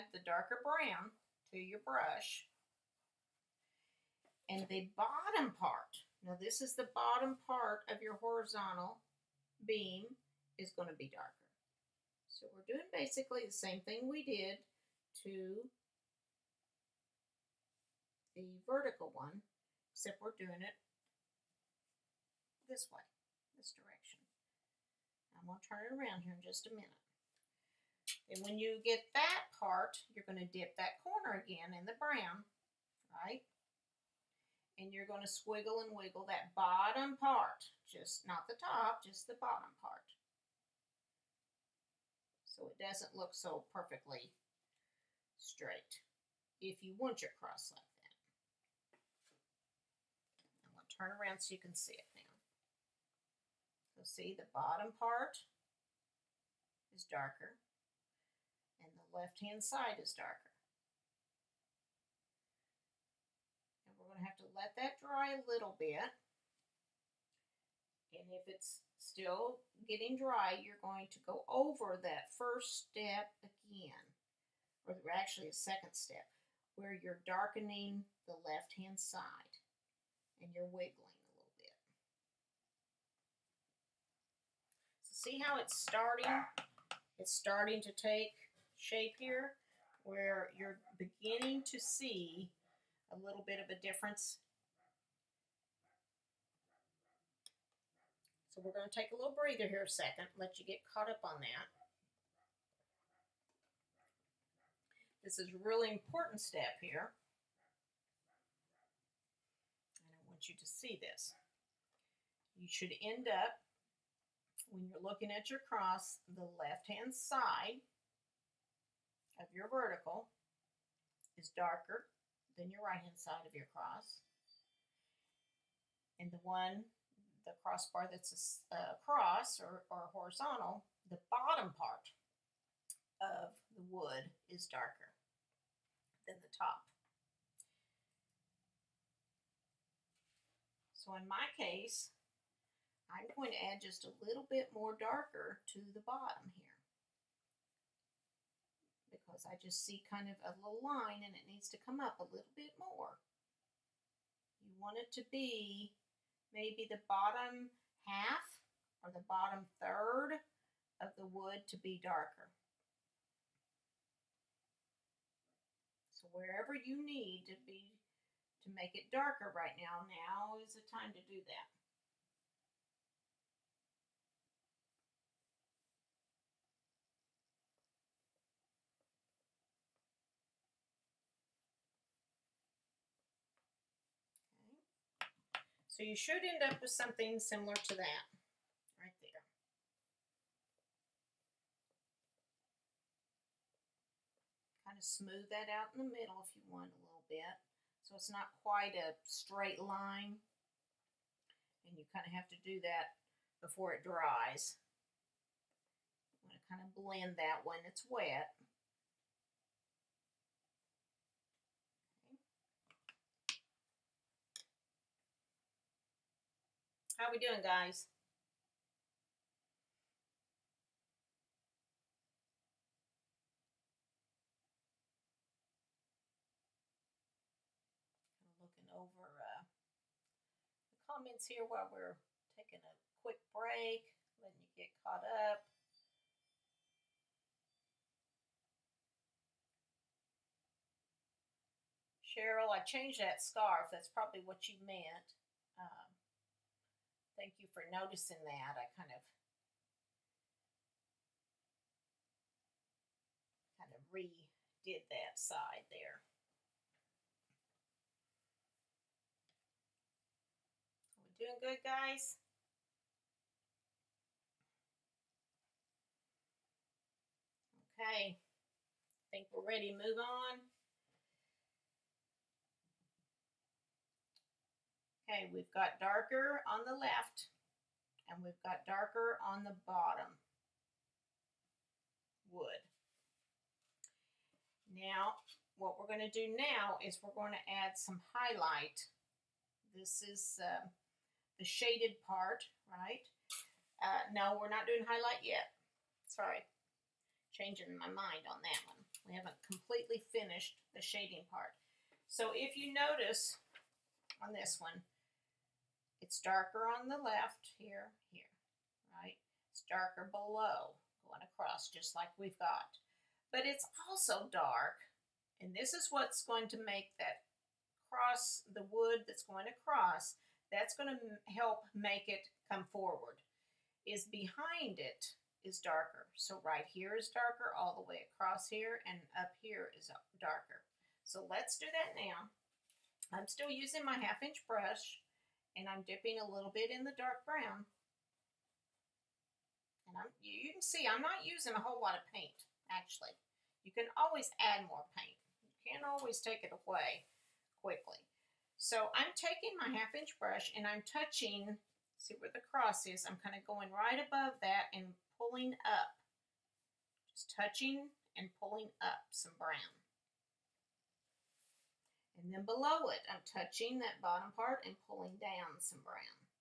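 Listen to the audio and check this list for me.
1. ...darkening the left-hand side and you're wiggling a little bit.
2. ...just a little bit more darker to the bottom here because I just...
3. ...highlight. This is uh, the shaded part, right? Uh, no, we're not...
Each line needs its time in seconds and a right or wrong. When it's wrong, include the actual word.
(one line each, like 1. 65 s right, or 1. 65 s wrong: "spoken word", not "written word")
1. 77 s right
2. 143 s right
3. 288 s right.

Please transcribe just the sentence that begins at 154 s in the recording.
You want it to be maybe the bottom half or the bottom third of the wood to be darker.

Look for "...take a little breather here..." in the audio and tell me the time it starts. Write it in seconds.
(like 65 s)
98 s.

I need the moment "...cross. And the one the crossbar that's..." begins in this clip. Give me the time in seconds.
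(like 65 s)
123 s.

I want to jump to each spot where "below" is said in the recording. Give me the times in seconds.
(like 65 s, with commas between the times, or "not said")
310 s, 362 s.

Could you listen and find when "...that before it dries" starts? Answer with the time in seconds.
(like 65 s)
202 s.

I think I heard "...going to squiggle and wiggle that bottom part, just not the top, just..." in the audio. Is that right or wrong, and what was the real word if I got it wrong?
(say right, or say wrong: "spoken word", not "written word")
right.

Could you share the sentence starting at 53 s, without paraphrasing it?
So see the bottom part is darker and the left hand side is darker.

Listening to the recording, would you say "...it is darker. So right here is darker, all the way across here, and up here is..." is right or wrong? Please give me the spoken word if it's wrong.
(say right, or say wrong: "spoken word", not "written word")
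right.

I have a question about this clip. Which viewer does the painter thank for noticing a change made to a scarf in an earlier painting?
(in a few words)
Cheryl.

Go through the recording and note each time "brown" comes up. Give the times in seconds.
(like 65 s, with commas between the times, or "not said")
0 s, 31 s, 337 s, 359 s, 366 s.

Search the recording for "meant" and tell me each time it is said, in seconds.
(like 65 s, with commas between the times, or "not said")
244 s.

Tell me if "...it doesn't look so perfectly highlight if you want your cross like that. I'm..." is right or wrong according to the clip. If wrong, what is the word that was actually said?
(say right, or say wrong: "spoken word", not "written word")
wrong: "straight", not "highlight".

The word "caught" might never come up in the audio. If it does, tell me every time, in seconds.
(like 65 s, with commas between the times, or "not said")
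100 s, 235 s.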